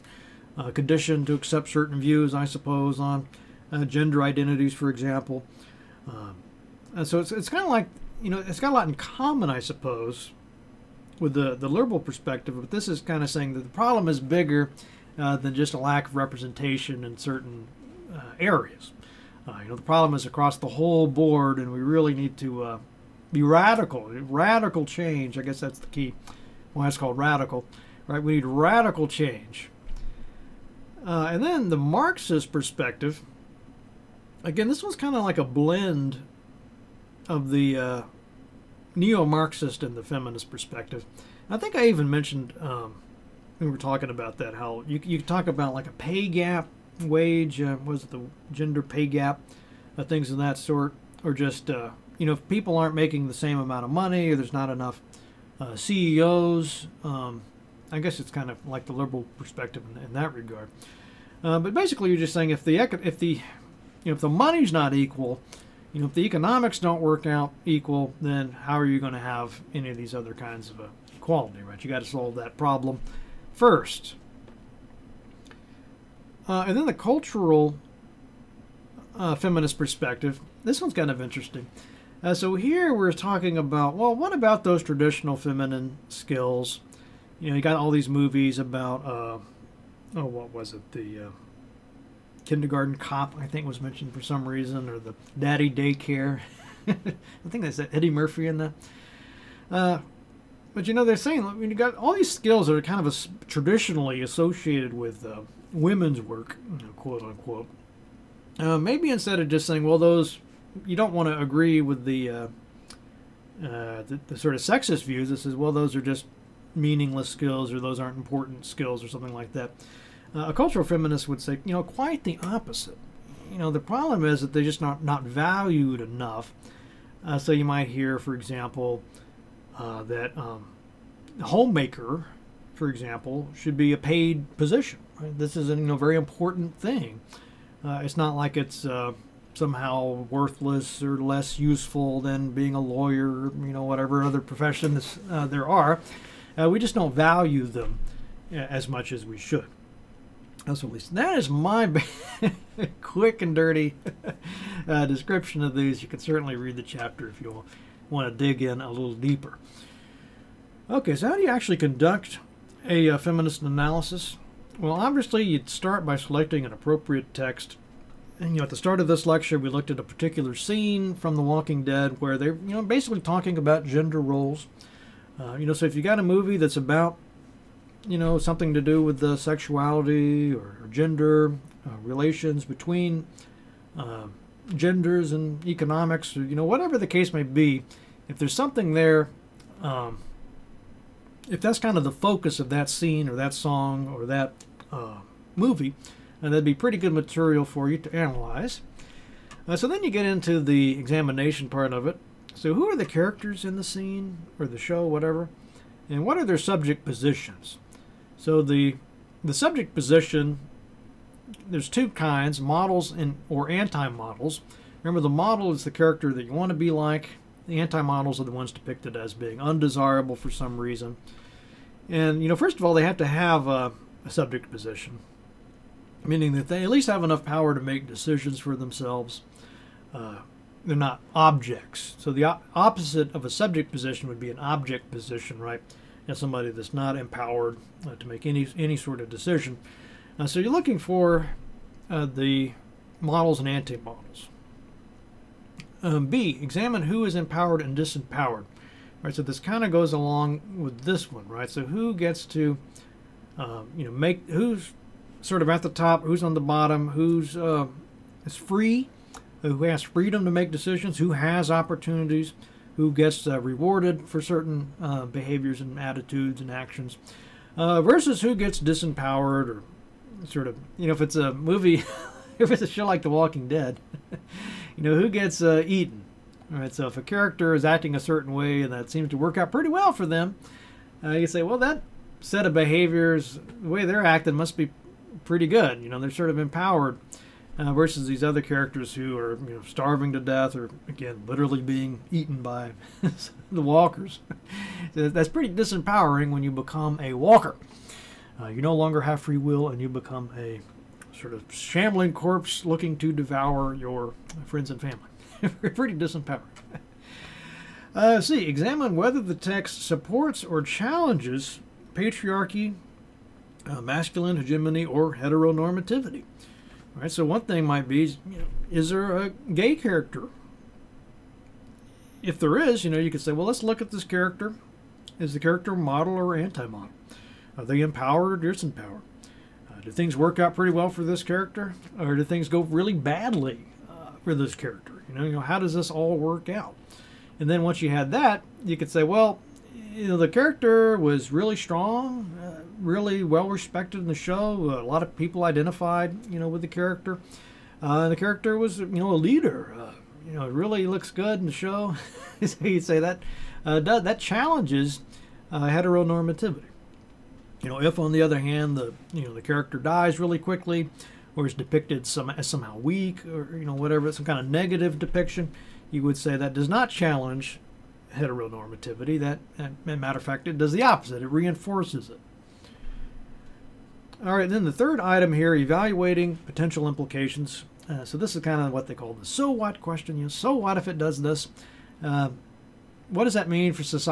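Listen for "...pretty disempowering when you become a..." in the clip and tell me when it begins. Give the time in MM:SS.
04:55.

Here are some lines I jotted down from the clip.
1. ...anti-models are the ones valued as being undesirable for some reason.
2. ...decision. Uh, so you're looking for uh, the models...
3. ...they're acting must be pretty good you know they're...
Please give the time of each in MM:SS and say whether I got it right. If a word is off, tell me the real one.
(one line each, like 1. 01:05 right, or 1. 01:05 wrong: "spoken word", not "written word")
1. 03:37 wrong: "depicted", not "valued"
2. 03:59 right
3. 04:44 right.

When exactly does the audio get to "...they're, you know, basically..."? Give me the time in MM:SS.
02:52.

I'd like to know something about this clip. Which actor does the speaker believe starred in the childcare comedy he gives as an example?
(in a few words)
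Eddie Murphy.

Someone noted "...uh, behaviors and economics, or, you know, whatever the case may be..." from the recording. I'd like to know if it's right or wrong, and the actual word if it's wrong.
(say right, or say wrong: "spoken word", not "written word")
wrong: "genders", not "behaviors".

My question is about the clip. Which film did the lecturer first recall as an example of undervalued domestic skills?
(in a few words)
Kindergarten Cop.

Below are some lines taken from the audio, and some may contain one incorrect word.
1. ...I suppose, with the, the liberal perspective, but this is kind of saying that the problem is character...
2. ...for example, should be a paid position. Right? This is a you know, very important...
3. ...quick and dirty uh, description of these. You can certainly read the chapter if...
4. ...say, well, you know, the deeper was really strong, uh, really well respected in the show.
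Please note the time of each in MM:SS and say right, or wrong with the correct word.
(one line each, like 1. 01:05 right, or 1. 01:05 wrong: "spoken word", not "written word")
1. 00:09 wrong: "bigger", not "character"
2. 02:12 right
3. 02:33 right
4. 05:39 wrong: "character", not "deeper".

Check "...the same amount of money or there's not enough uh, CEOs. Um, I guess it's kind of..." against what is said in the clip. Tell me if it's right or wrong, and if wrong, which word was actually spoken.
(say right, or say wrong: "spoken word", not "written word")
right.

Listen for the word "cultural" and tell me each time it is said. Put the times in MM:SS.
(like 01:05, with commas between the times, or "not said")
01:16, 02:00.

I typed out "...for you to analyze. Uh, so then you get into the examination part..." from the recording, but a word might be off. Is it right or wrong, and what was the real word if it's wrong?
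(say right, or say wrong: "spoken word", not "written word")
right.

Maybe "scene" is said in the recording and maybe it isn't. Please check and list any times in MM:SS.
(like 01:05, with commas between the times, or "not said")
02:50, 03:12, 03:23.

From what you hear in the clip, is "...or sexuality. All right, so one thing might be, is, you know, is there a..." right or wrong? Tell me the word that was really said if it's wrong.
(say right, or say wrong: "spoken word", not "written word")
wrong: "heteronormativity", not "sexuality".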